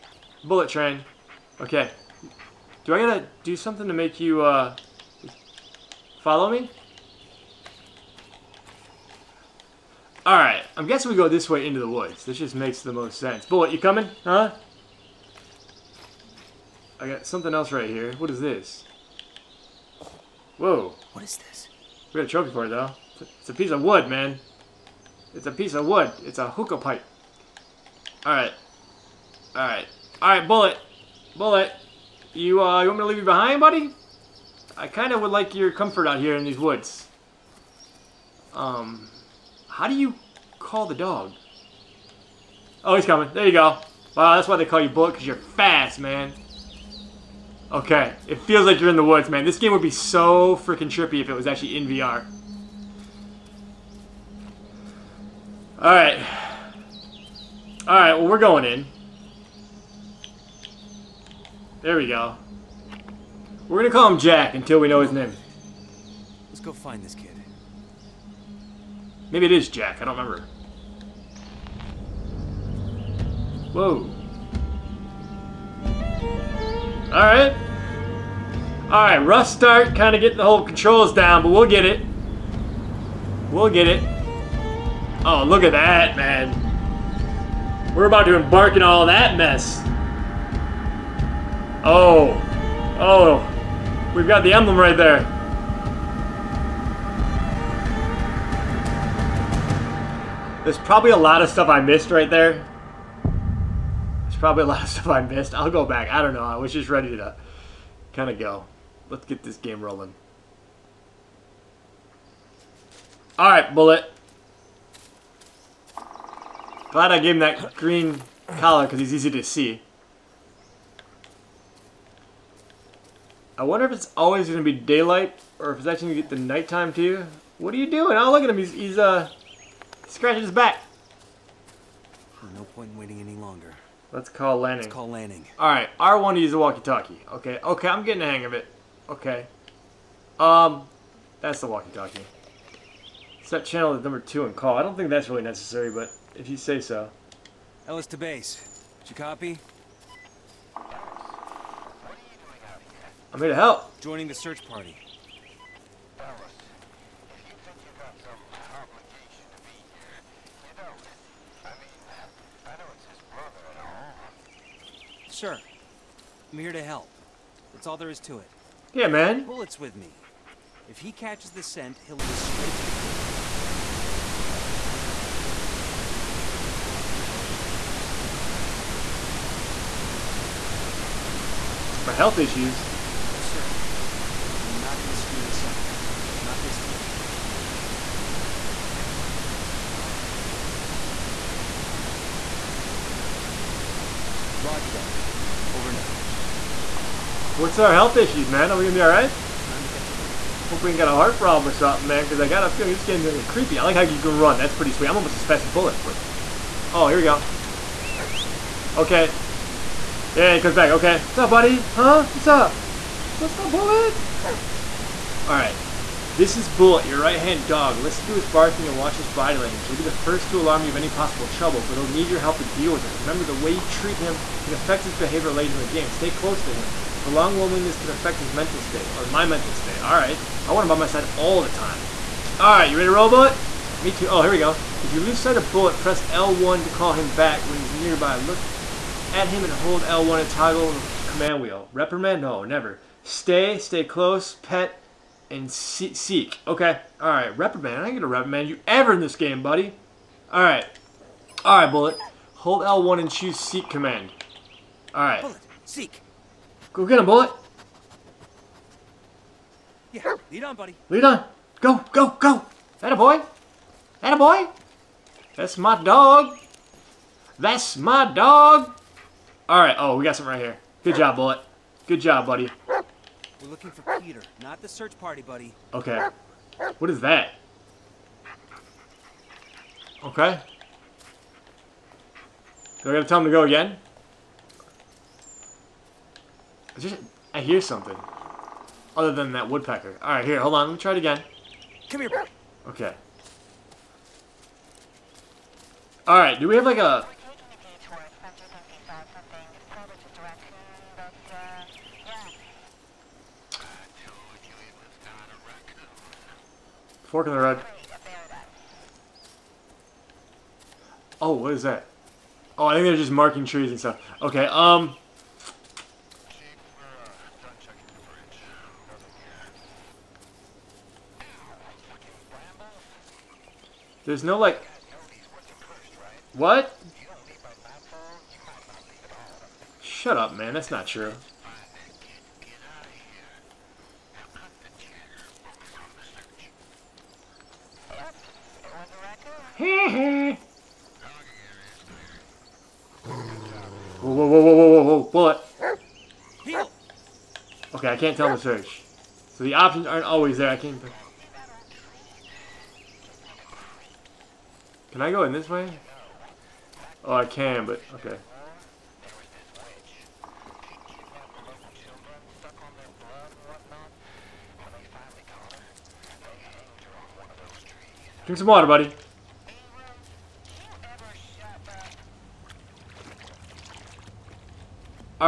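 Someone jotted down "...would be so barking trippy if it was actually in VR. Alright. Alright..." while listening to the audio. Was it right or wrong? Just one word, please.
wrong.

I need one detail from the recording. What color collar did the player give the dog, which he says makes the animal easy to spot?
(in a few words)
Green.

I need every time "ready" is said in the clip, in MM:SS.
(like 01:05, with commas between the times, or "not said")
01:46, 03:52.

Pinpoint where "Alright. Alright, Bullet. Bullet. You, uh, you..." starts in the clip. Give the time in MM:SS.
00:29.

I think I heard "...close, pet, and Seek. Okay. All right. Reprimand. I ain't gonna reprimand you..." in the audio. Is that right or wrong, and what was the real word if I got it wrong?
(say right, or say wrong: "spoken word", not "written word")
right.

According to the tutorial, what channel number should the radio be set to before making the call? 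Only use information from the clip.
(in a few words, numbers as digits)
2.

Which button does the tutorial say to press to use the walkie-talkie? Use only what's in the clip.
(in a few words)
R1.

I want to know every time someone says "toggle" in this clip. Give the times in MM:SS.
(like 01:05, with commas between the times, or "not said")
04:00.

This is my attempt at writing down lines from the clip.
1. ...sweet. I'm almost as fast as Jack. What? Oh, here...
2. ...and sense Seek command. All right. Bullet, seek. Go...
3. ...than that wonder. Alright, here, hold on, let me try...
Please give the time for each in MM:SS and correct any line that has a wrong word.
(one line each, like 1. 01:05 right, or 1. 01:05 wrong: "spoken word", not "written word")
1. 03:24 wrong: "Bullet", not "Jack"
2. 04:13 wrong: "choose", not "sense"
3. 04:49 wrong: "woodpecker", not "wonder".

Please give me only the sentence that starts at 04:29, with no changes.
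Oh, we got some right here.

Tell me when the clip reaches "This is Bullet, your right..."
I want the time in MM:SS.
03:36.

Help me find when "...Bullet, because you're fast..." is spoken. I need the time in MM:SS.
00:44.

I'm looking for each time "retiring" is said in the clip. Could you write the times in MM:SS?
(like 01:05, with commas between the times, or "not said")
not said.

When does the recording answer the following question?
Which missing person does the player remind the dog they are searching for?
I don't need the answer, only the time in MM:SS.
04:34.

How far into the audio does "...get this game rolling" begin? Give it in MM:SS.
01:49.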